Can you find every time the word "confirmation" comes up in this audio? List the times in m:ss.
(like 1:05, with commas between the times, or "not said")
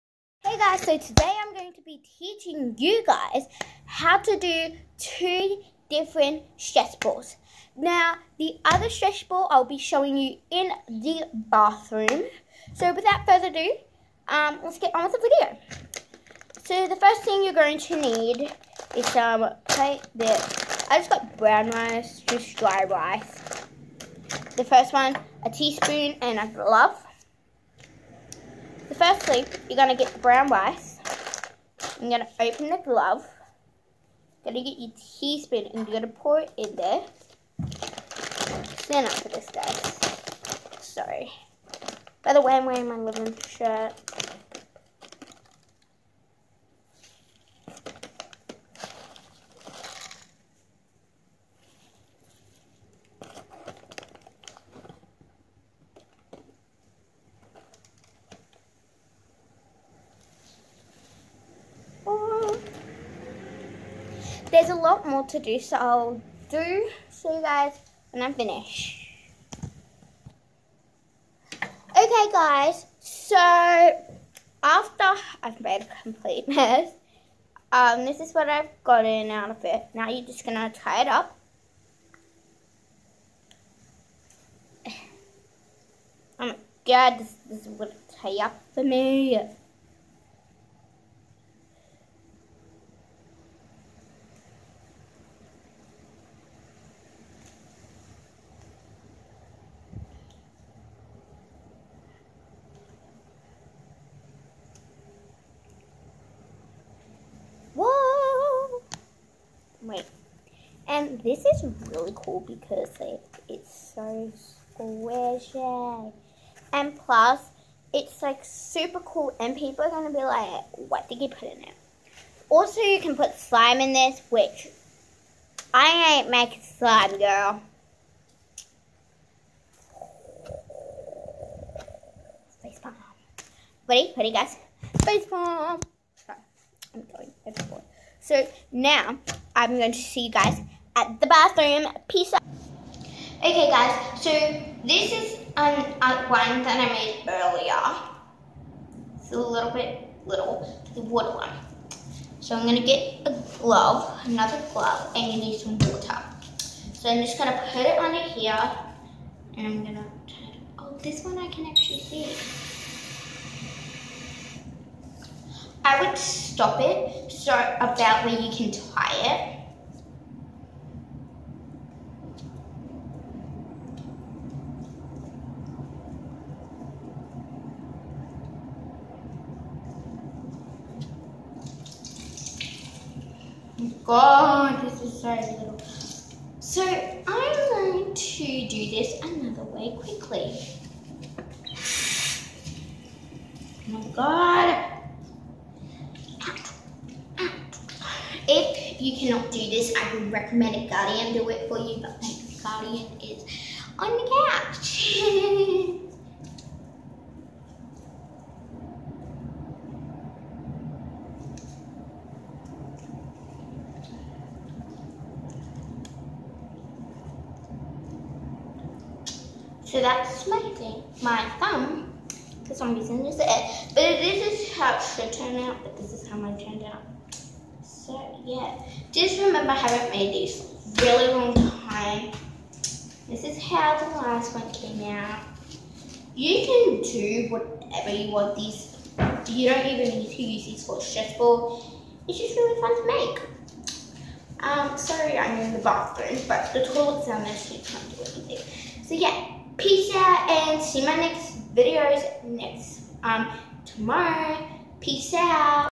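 not said.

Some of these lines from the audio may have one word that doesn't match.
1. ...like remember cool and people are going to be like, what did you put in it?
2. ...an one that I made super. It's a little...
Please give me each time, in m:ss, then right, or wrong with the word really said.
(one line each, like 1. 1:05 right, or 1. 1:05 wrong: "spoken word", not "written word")
1. 1:58 wrong: "super", not "remember"
2. 2:25 wrong: "earlier", not "super".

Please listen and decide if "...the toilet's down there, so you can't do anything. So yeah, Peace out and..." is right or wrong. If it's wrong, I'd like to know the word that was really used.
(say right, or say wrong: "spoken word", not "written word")
right.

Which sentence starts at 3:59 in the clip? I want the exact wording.
You don't even need to use these for balls.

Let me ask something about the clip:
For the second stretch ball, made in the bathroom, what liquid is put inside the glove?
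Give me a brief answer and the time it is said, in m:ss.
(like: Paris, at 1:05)
water, at 2:35.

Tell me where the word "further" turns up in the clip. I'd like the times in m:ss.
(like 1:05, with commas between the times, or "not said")
0:13.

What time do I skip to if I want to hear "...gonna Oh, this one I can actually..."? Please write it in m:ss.
2:39.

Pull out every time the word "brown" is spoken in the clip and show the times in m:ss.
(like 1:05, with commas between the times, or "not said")
0:21, 0:30.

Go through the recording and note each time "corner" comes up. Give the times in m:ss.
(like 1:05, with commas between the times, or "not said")
not said.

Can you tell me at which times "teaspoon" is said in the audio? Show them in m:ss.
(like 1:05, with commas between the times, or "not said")
0:25, 0:35.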